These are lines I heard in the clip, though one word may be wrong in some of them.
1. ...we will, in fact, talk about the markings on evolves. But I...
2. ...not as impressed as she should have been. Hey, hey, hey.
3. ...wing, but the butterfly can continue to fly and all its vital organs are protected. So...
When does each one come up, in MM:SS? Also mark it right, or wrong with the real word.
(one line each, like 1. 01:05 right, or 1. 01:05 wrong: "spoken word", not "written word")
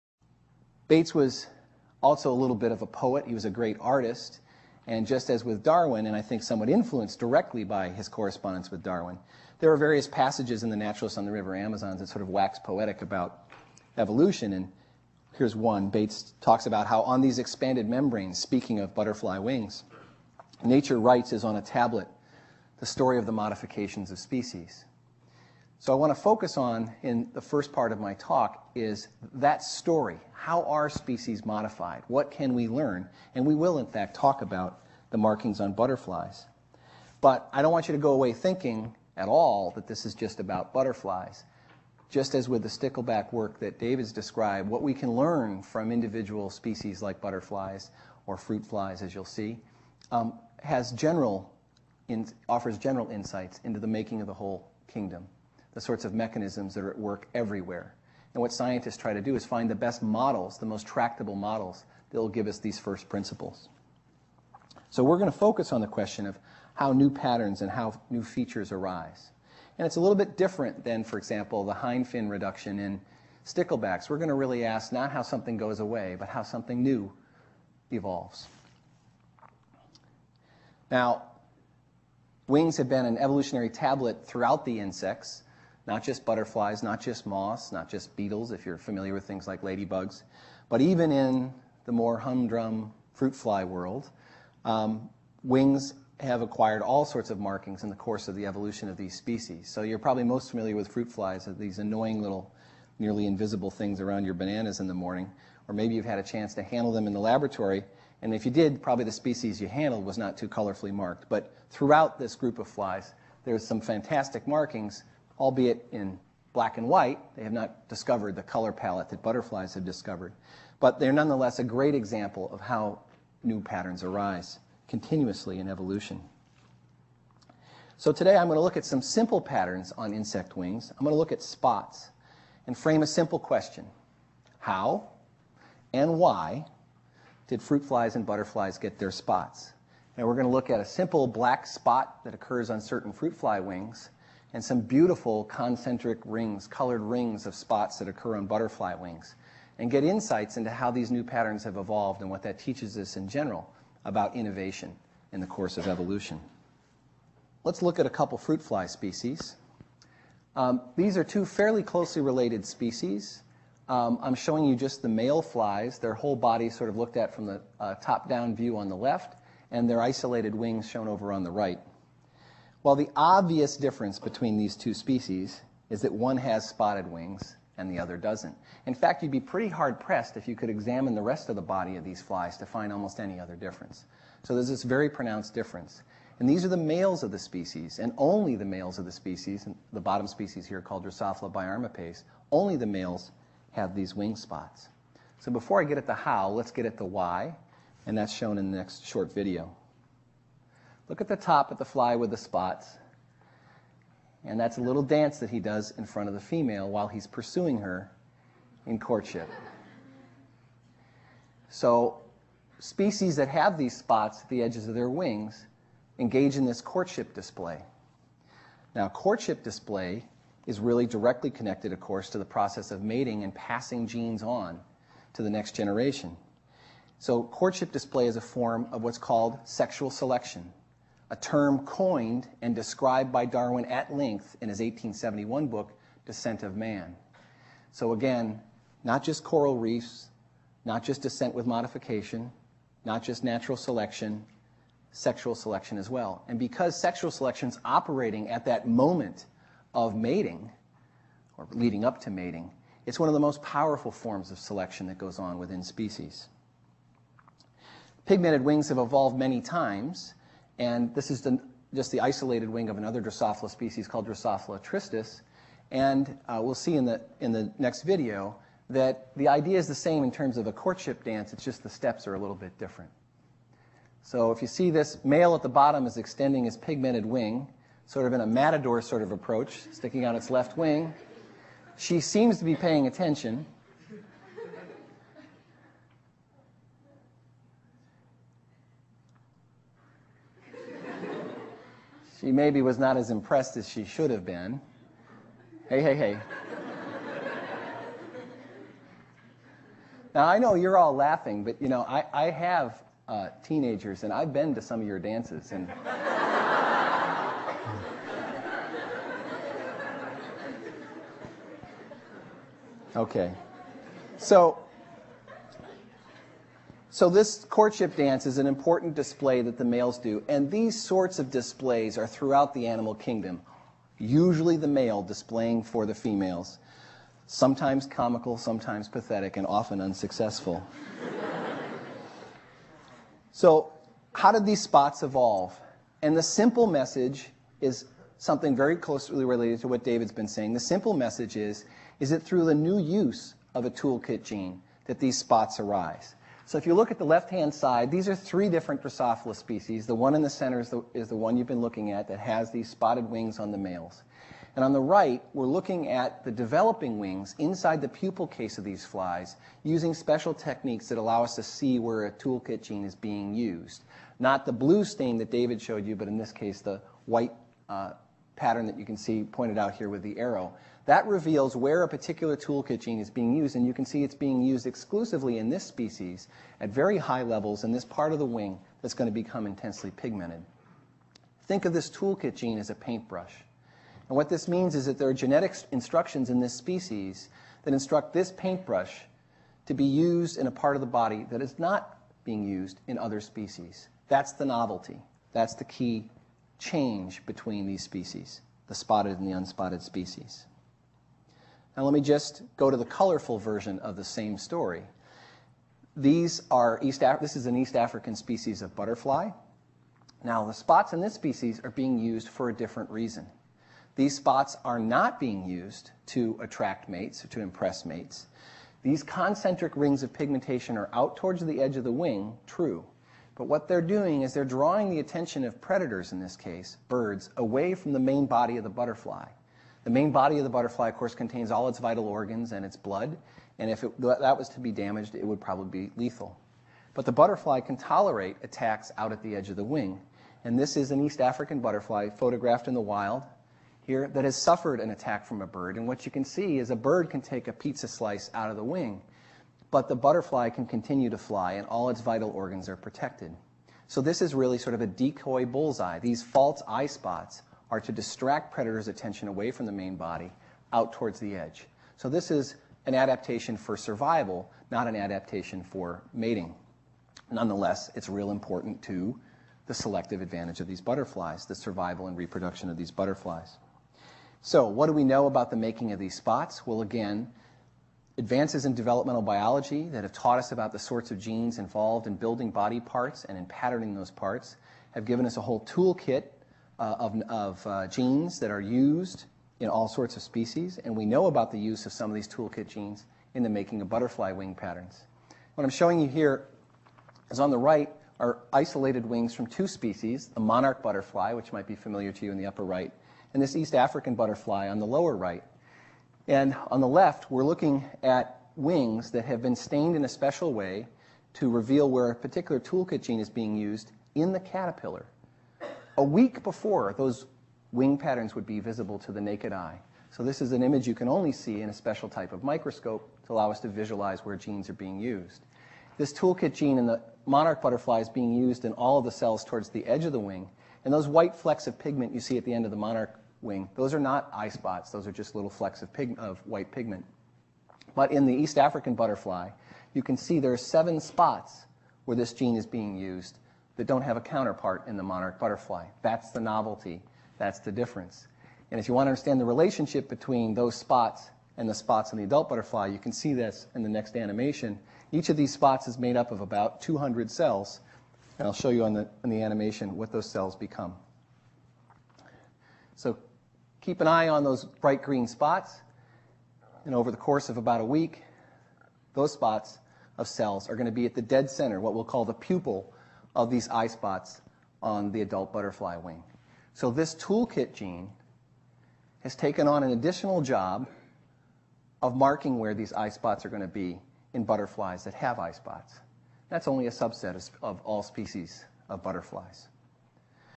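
1. 00:33 wrong: "butterflies", not "evolves"
2. 04:52 right
3. 07:28 right.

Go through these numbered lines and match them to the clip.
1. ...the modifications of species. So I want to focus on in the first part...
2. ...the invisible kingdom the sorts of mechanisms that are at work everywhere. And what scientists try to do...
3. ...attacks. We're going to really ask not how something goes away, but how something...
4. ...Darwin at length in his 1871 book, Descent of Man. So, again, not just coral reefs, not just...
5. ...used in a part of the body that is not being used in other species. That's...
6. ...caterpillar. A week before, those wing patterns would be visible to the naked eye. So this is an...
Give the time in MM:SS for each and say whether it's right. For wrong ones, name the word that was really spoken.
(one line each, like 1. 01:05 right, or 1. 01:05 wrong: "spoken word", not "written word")
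1. 00:23 right
2. 00:54 wrong: "whole", not "invisible"
3. 01:13 wrong: "sticklebacks", not "attacks"
4. 03:53 right
5. 06:30 right
6. 08:34 right.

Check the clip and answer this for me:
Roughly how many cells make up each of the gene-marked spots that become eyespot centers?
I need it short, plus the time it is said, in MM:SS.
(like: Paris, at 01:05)
200, at 09:17.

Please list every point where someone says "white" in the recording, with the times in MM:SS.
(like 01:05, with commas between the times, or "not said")
01:56, 06:07, 08:51, 08:56.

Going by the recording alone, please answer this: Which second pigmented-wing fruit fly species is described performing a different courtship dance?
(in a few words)
Drosophila tristis.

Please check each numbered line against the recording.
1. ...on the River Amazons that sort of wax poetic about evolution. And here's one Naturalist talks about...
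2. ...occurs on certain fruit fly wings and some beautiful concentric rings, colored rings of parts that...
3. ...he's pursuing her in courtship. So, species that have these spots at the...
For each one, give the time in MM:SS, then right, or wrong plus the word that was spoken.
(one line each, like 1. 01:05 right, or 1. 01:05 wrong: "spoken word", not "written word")
1. 00:11 wrong: "Bates", not "Naturalist"
2. 02:22 wrong: "spots", not "parts"
3. 03:27 right.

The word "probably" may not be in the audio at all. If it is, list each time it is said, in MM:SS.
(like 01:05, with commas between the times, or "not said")
01:39, 01:48, 07:15.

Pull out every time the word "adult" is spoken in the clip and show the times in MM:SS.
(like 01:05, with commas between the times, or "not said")
09:12, 09:35.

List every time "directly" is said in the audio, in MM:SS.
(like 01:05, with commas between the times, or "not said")
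00:07, 03:41.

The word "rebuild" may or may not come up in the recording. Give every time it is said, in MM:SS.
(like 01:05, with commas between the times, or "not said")
not said.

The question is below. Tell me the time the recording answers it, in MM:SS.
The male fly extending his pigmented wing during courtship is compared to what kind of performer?
04:38.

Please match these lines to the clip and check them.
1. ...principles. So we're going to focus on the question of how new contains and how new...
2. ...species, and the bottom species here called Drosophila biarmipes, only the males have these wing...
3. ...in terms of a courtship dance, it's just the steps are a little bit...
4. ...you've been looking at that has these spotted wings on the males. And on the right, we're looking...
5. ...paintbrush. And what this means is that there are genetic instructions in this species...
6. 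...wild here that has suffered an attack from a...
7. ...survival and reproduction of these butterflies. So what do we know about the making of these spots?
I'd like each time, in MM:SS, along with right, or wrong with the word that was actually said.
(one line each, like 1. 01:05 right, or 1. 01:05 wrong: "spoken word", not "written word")
1. 01:03 wrong: "patterns", not "contains"
2. 03:09 right
3. 04:30 right
4. 05:51 right
5. 06:22 right
6. 07:22 right
7. 07:51 right.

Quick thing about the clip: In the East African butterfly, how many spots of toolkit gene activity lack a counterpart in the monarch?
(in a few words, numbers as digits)
7.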